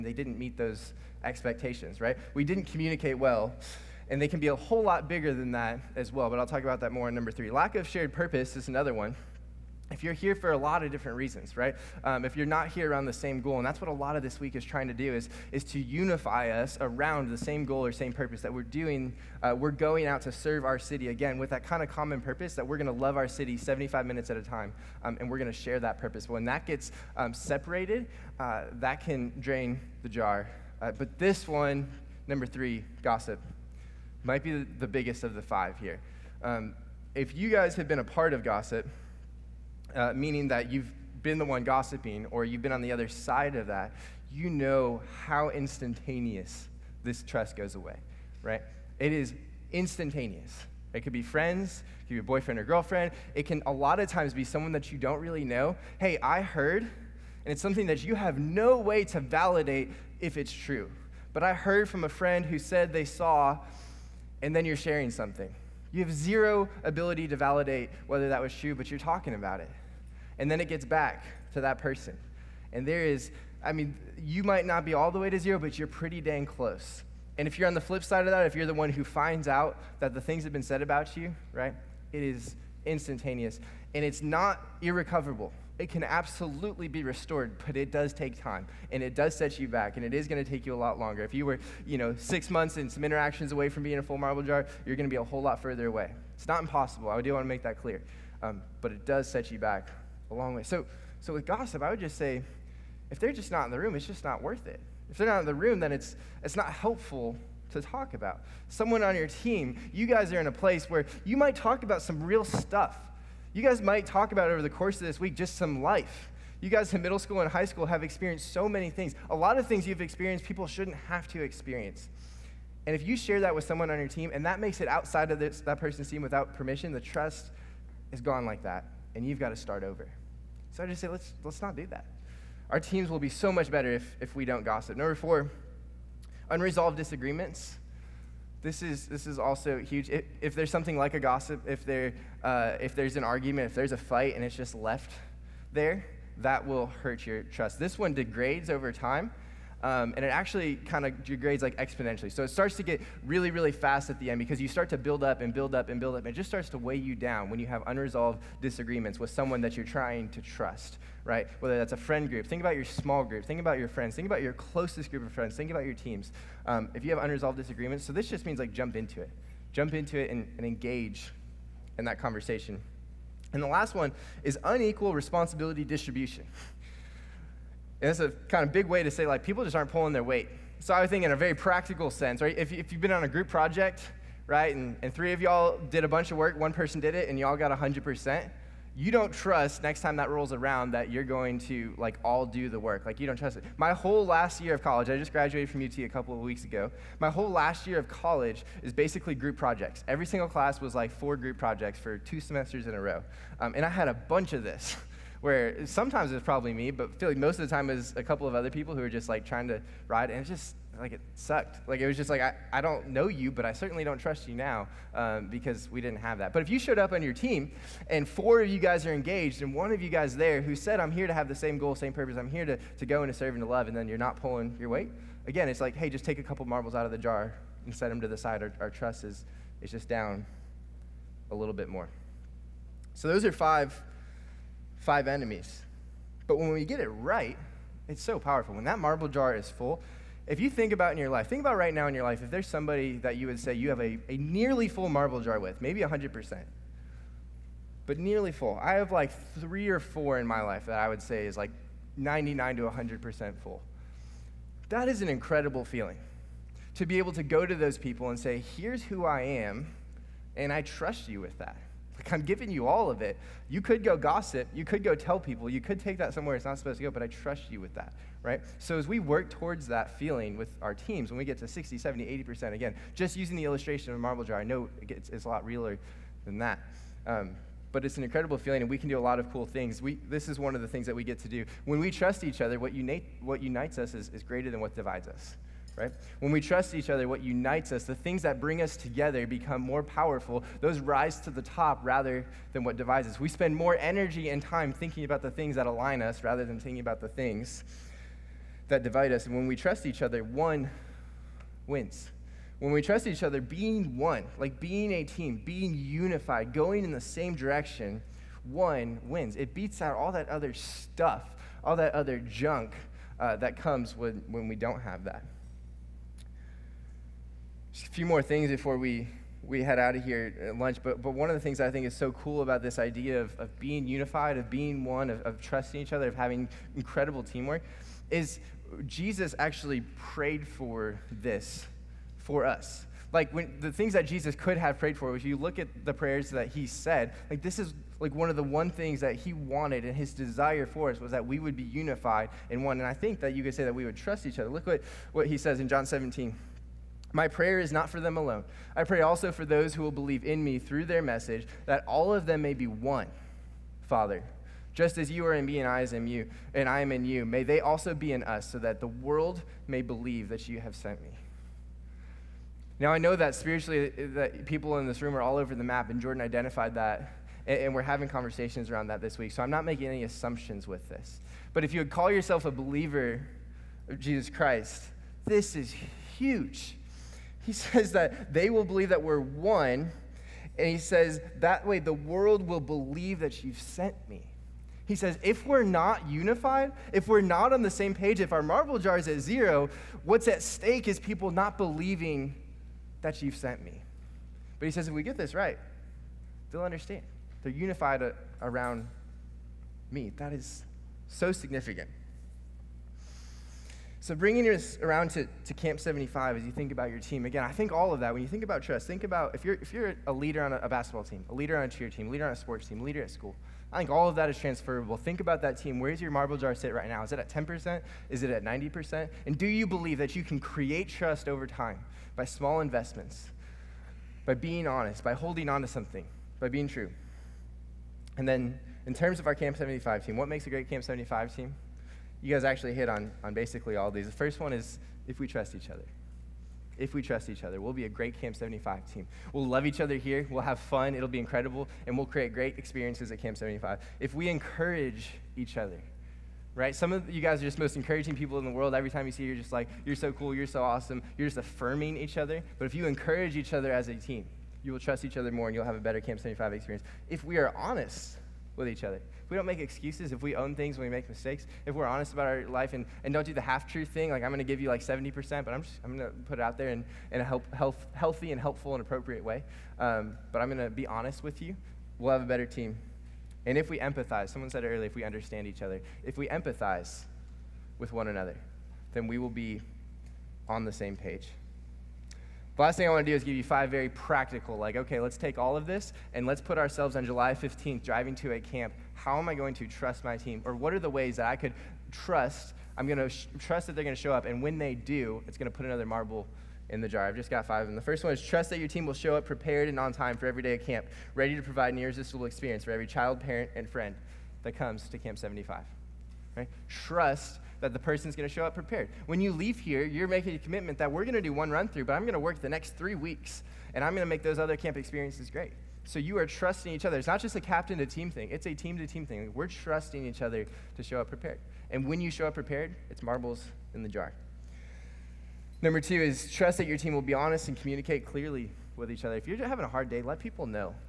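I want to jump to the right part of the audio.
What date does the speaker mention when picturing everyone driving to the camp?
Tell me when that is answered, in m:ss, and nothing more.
8:07.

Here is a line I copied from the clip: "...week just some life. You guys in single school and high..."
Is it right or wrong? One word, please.
wrong.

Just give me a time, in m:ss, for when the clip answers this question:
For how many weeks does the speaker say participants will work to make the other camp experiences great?
8:32.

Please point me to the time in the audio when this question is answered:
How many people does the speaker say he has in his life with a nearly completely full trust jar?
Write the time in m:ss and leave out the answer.
4:09.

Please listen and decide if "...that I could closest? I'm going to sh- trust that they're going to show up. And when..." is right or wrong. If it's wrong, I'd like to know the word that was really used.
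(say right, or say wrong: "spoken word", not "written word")
wrong: "trust", not "closest".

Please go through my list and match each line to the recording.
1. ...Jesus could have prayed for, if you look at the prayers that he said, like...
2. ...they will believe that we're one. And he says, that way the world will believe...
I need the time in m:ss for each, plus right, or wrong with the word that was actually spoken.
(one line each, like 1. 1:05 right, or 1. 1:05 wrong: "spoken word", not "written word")
1. 5:34 right
2. 6:18 right.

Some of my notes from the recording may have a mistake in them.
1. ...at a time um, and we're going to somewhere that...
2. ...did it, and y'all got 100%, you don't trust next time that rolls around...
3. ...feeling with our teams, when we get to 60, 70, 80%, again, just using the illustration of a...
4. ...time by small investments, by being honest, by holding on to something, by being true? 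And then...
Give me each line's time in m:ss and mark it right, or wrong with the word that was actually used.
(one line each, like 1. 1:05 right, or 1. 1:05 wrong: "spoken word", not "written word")
1. 0:24 wrong: "share", not "somewhere"
2. 3:06 right
3. 4:30 right
4. 7:01 right.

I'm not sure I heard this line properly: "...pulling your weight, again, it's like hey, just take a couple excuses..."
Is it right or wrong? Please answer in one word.
wrong.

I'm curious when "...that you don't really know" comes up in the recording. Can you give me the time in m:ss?
0:54.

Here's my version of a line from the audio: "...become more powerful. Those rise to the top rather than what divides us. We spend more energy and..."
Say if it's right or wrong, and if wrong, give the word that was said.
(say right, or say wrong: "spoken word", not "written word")
right.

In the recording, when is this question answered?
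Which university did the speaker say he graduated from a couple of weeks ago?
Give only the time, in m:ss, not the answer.
3:15.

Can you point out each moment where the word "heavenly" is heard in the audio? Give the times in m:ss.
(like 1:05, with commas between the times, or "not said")
not said.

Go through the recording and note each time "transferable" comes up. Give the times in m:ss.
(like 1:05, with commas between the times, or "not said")
6:54.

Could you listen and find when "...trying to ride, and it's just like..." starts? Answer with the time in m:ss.
3:29.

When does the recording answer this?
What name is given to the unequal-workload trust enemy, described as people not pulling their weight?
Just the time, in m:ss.
2:54.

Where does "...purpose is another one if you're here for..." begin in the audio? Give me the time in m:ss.
0:08.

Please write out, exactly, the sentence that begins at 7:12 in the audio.
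you guys actually hit on, on basically all these.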